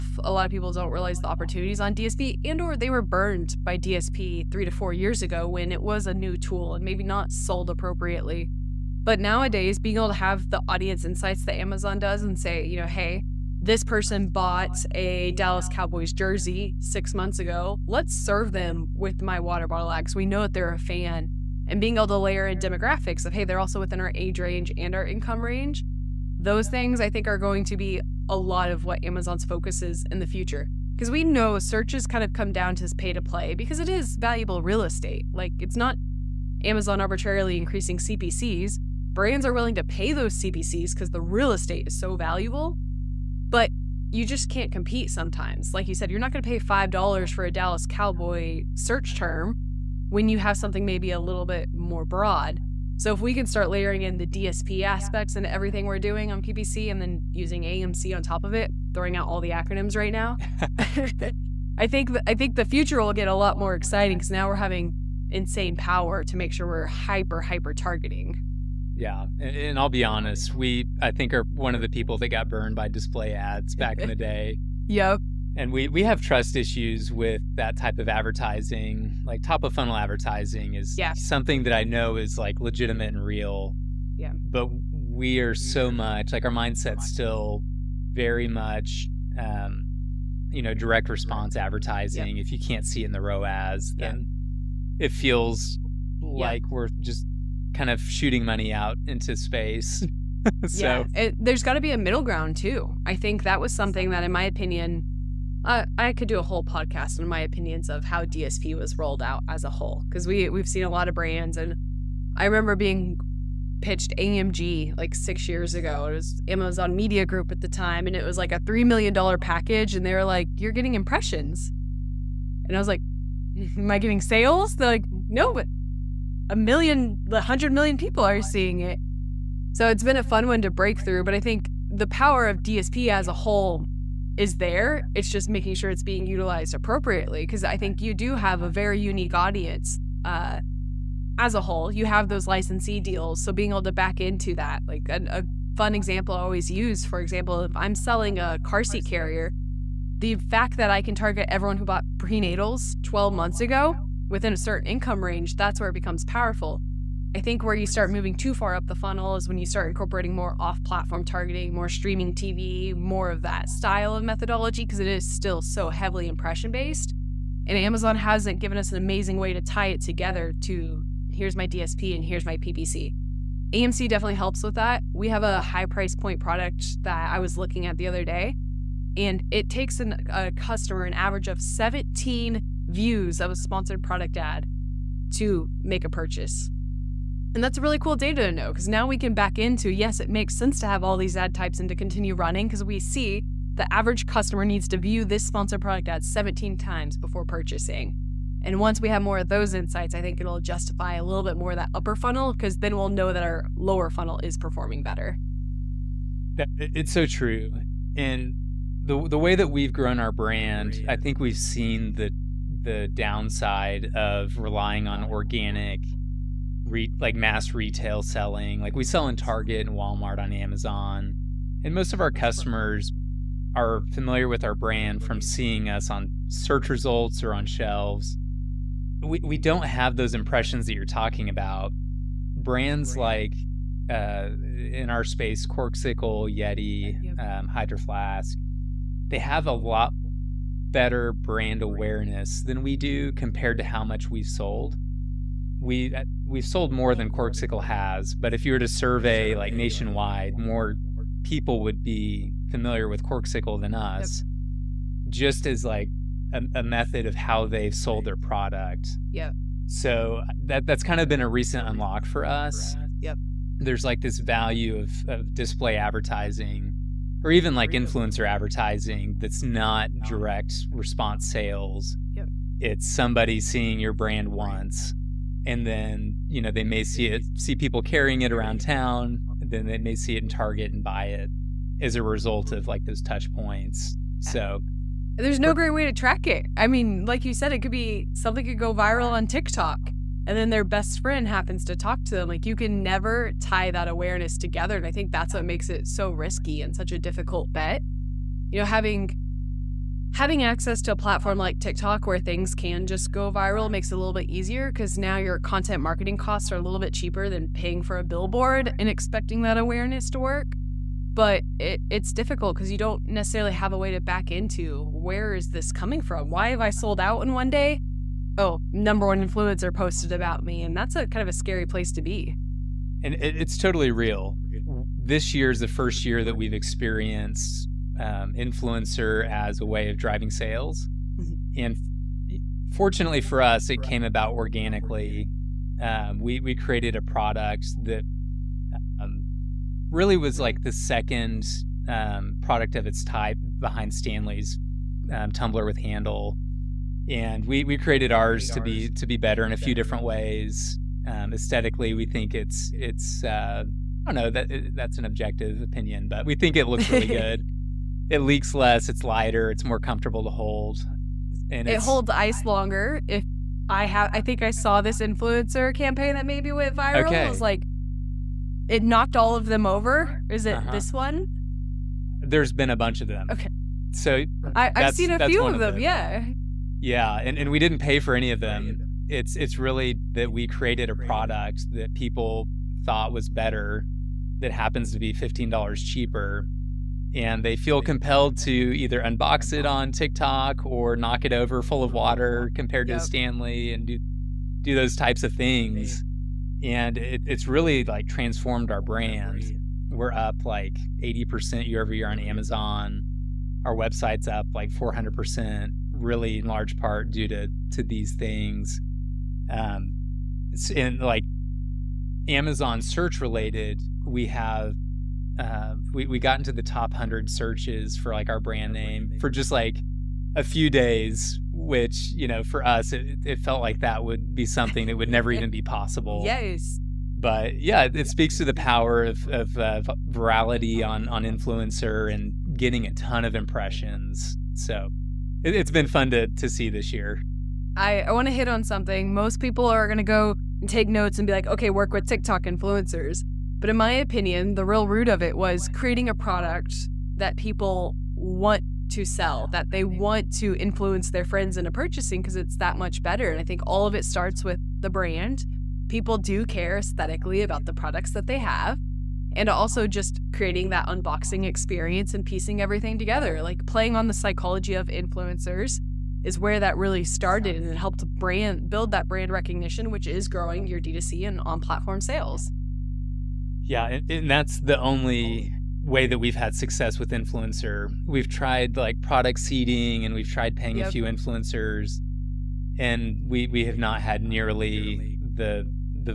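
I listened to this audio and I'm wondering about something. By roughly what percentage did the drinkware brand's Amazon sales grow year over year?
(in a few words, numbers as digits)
80%.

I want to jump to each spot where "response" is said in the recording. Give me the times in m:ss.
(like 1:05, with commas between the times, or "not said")
1:31, 4:30.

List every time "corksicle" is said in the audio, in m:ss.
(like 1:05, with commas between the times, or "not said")
3:55, 4:07, 4:13.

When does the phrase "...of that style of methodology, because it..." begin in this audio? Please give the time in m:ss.
2:43.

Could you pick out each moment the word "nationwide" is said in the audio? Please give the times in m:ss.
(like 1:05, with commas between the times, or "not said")
4:09.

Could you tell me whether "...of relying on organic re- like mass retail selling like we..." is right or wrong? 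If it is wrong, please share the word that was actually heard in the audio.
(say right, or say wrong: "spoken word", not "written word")
right.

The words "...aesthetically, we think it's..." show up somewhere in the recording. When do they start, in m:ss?
5:51.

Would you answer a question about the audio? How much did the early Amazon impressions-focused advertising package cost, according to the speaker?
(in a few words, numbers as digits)
3 million dollars.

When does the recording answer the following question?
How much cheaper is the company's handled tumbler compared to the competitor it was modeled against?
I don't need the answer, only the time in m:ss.
6:25.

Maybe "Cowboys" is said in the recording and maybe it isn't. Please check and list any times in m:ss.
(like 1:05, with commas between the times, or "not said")
0:15, 0:47.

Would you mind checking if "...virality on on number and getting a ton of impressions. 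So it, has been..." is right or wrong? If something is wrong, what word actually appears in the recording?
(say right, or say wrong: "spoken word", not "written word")
wrong: "influencer", not "number".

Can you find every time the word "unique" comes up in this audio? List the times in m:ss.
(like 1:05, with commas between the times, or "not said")
2:18.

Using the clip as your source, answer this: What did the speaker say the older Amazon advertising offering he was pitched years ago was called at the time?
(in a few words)
Amazon Media Group.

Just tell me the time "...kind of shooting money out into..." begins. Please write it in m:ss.
1:37.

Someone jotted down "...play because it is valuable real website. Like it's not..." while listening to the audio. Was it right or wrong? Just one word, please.
wrong.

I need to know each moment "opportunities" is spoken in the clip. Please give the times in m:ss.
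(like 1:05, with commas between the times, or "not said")
0:01.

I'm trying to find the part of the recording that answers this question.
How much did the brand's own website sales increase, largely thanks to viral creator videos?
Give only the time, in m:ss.
6:44.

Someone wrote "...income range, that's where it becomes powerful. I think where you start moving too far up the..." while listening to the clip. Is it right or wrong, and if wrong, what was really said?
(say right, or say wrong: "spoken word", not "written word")
right.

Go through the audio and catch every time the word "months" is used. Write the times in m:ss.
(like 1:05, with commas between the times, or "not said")
0:17, 2:33.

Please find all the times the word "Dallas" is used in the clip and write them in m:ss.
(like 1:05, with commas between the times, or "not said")
0:15, 0:47.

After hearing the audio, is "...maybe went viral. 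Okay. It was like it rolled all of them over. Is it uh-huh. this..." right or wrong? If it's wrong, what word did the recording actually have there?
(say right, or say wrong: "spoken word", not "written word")
wrong: "knocked", not "rolled".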